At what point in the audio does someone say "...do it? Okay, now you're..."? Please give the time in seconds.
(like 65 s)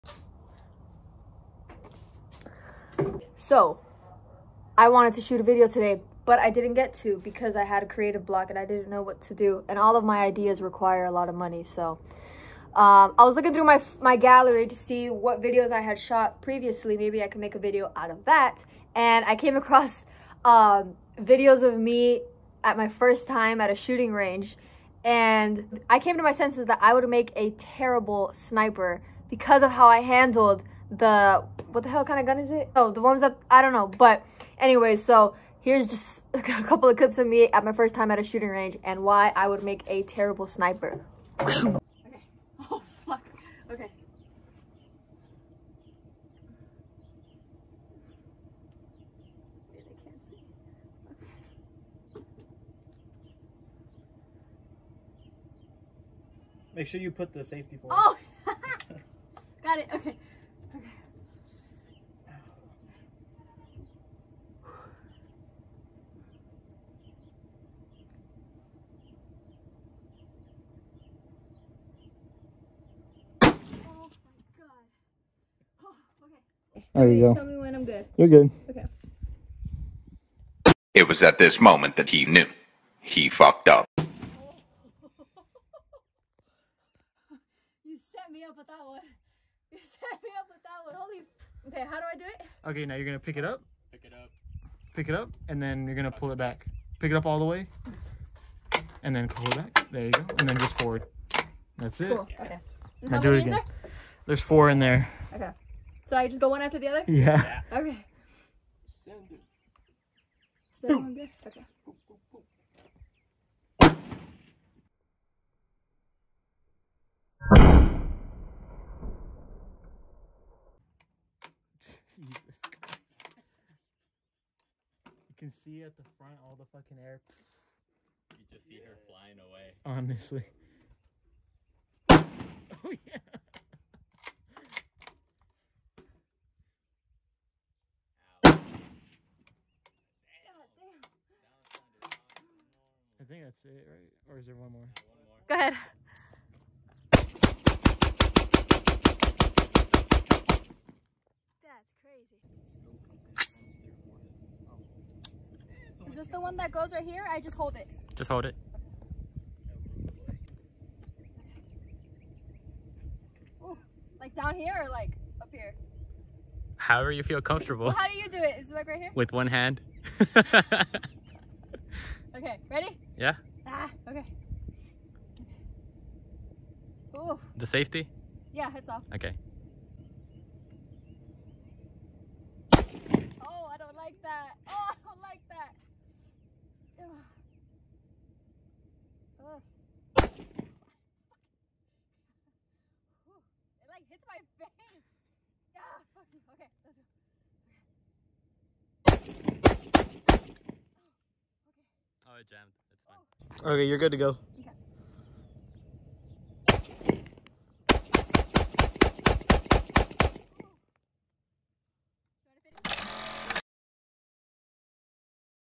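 92 s.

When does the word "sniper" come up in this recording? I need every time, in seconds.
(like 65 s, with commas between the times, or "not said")
28 s, 40 s.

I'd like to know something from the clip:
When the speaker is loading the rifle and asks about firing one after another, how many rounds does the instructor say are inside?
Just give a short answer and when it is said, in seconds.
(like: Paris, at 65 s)
4, at 104 s.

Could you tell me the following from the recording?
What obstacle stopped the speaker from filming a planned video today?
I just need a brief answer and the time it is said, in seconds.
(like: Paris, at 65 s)
Creative block, at 7 s.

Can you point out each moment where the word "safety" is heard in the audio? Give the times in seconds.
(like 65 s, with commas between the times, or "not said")
57 s, 177 s.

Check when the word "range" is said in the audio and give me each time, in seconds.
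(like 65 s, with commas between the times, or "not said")
24 s, 38 s.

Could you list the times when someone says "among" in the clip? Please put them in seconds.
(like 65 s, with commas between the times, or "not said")
not said.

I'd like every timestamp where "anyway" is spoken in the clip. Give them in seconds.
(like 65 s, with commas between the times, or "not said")
34 s.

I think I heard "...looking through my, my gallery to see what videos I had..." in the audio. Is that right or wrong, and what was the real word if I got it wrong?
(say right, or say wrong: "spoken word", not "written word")
right.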